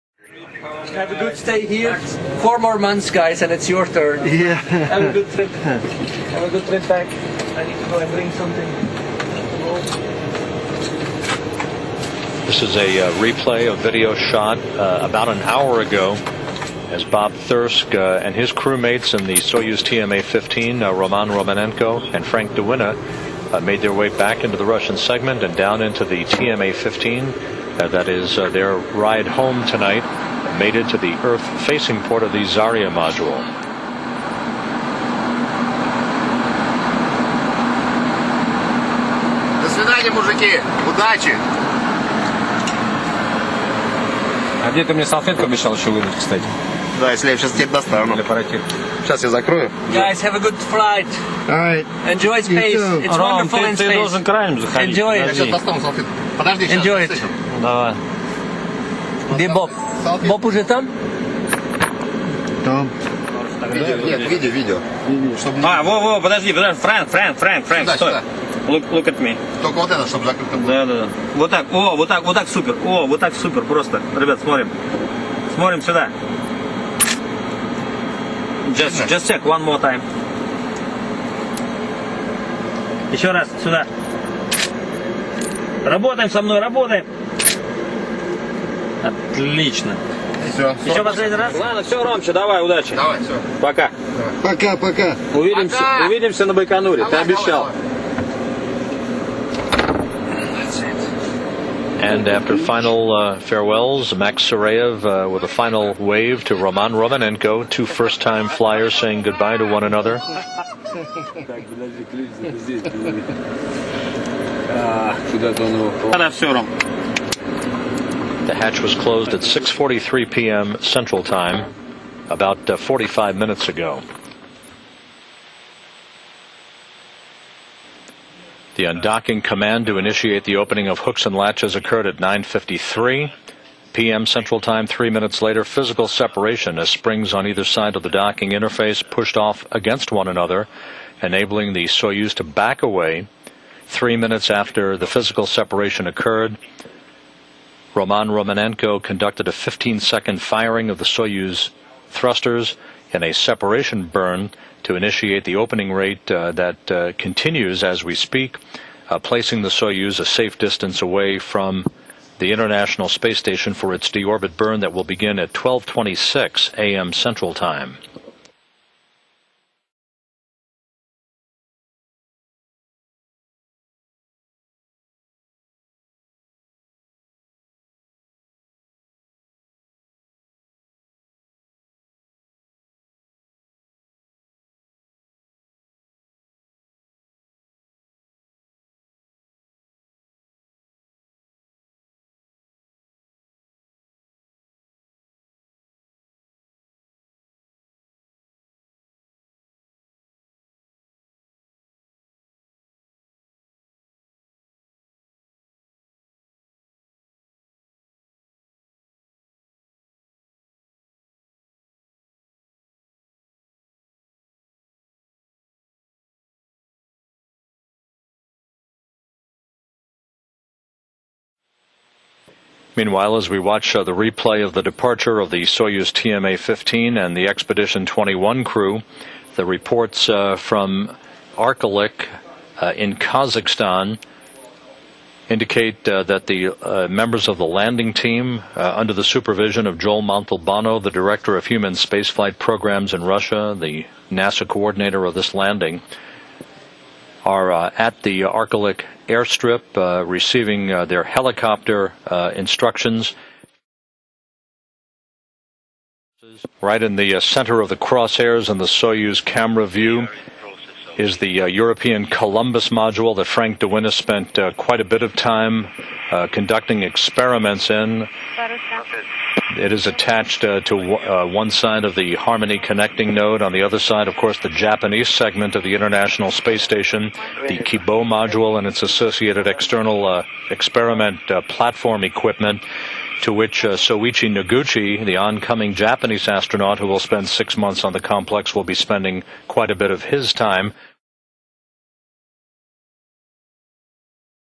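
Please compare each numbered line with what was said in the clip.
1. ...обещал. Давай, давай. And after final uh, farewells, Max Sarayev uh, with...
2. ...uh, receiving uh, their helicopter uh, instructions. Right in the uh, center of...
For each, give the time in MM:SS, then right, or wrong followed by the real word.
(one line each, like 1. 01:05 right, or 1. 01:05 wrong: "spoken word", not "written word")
1. 01:37 right
2. 04:09 right.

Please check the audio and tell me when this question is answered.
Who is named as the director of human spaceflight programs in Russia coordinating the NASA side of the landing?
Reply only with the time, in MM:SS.
03:59.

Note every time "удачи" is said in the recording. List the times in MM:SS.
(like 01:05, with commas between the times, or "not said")
00:40, 01:32.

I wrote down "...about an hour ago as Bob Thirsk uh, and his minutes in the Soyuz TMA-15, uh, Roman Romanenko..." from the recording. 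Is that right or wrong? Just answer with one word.
wrong.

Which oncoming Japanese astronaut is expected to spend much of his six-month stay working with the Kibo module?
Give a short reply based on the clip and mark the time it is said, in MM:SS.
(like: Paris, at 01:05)
Soichi Noguchi, at 04:43.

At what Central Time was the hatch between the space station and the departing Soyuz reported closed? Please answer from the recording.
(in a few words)
6:43 p.m.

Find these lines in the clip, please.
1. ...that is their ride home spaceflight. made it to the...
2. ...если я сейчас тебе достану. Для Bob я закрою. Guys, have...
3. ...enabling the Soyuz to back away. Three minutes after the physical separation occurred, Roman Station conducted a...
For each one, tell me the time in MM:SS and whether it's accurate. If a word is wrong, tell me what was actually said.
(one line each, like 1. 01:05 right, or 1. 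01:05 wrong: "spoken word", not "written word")
1. 00:27 wrong: "tonight", not "spaceflight"
2. 00:47 wrong: "Сейчас", not "Bob"
3. 02:21 wrong: "Romanenko", not "Station".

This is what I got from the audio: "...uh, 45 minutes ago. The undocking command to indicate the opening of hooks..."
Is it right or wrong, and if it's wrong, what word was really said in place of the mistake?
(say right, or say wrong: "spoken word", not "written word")
wrong: "initiate", not "indicate".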